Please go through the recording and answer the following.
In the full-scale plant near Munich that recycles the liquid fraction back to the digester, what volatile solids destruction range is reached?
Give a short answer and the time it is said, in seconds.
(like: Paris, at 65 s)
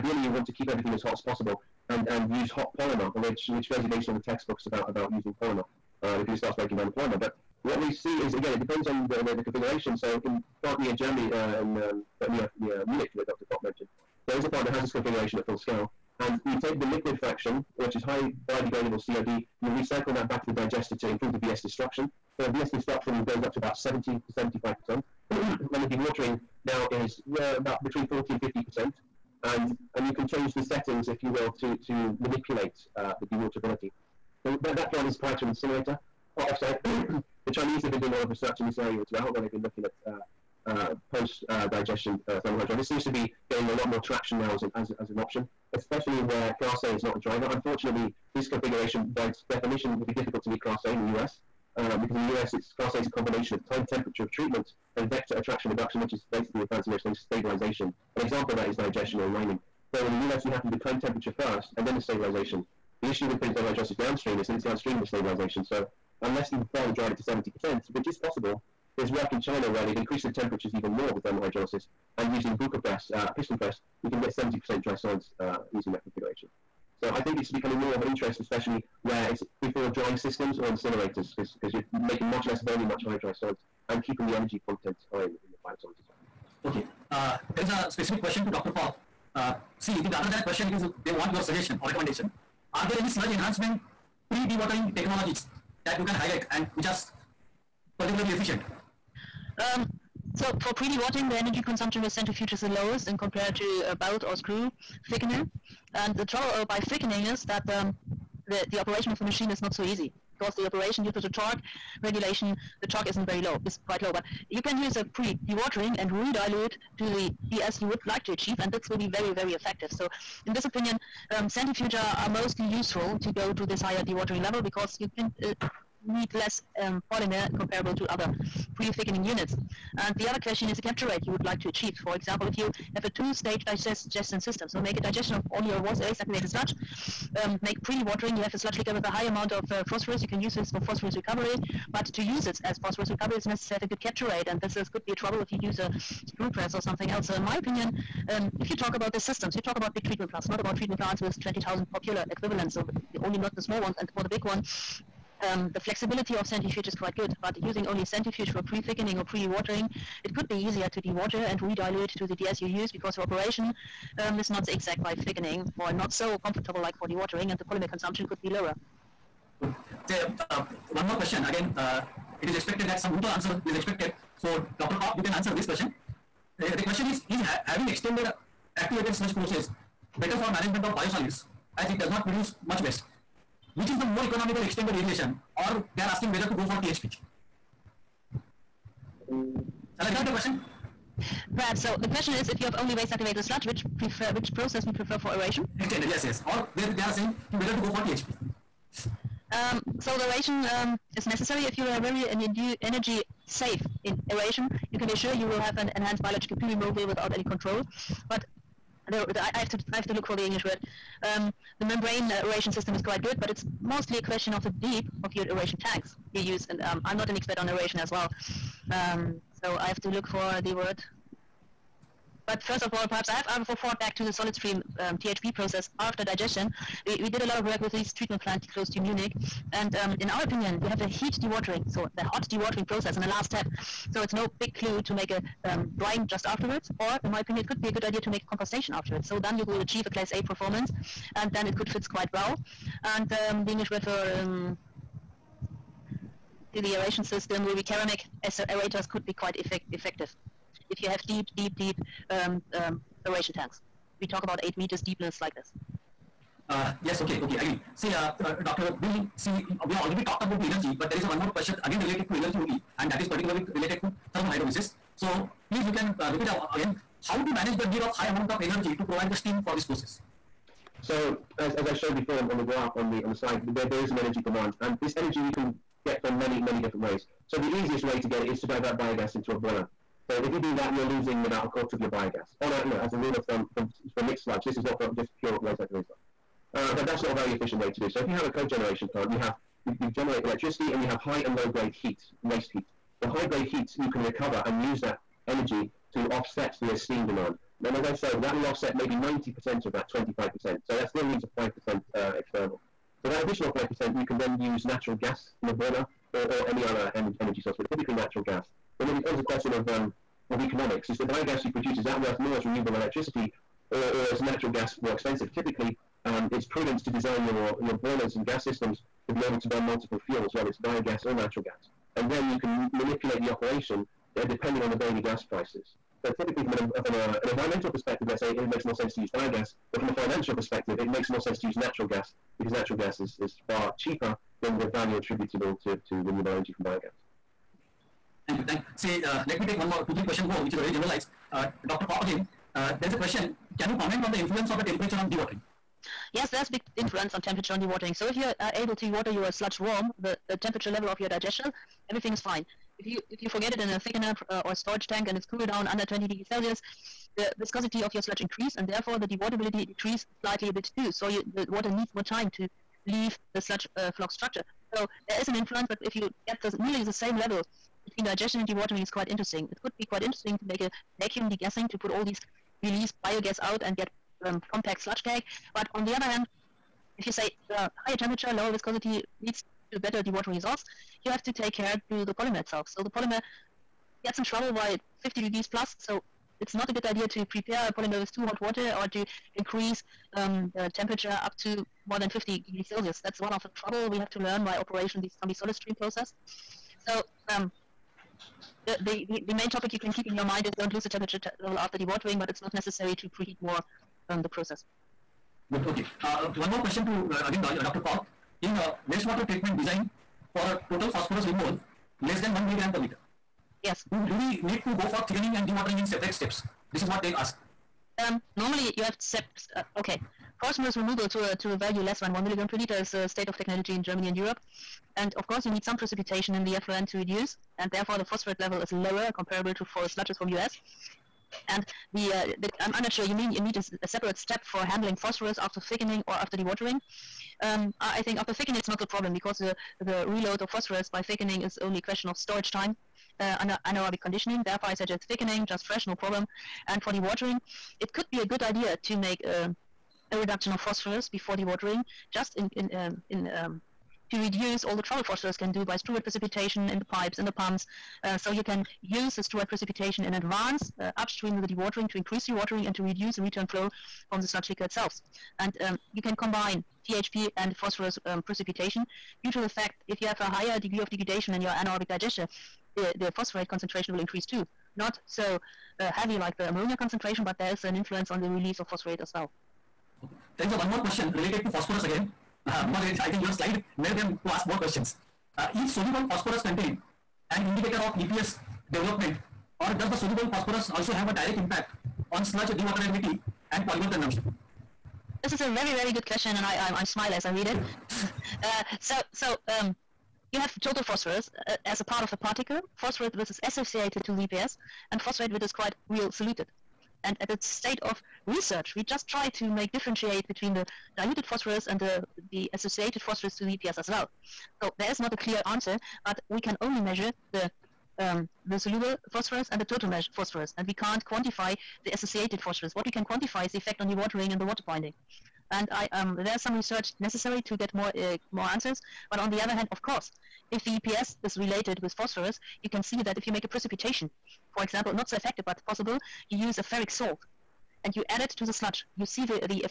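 70 to 75%, at 23 s.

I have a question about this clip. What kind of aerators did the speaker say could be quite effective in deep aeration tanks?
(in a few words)
ceramic.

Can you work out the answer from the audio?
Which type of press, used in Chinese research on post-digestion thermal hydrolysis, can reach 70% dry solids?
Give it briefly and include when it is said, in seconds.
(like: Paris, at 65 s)
Bucher press, at 72 s.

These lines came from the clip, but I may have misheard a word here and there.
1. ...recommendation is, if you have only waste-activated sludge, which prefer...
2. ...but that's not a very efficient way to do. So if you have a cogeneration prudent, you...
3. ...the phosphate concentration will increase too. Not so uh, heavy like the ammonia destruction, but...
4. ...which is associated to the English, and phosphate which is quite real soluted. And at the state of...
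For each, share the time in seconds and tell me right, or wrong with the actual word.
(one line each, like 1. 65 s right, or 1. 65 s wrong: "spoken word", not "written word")
1. 192 s wrong: "question", not "recommendation"
2. 286 s wrong: "plant", not "prudent"
3. 473 s wrong: "concentration", not "destruction"
4. 503 s wrong: "EPS", not "English".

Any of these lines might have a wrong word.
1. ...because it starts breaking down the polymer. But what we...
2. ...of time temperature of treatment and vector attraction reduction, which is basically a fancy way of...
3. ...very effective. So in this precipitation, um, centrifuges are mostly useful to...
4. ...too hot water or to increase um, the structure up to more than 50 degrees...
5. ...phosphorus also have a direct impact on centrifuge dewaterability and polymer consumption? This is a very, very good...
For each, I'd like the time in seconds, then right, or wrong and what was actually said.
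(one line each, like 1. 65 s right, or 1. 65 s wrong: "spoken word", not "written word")
1. 6 s right
2. 53 s right
3. 119 s wrong: "opinion", not "precipitation"
4. 388 s wrong: "temperature", not "structure"
5. 490 s wrong: "sludge", not "centrifuge".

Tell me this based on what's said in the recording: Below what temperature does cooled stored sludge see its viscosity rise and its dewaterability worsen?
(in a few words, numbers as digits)
20 degrees Celsius.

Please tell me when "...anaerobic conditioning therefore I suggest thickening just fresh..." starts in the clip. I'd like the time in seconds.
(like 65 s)
443 s.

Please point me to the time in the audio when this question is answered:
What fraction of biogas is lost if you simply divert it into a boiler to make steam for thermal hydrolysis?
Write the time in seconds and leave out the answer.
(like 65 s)
281 s.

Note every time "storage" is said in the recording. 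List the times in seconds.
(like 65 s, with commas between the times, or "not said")
354 s, 442 s.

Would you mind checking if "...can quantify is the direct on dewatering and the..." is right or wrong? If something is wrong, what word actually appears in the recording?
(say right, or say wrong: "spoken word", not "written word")
wrong: "effect", not "direct".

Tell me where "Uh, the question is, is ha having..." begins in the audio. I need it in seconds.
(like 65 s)
176 s.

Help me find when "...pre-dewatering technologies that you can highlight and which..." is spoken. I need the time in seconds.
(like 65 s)
94 s.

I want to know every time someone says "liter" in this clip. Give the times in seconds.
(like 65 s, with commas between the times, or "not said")
412 s, 422 s.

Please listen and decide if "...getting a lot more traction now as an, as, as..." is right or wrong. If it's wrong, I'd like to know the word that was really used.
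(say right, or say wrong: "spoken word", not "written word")
right.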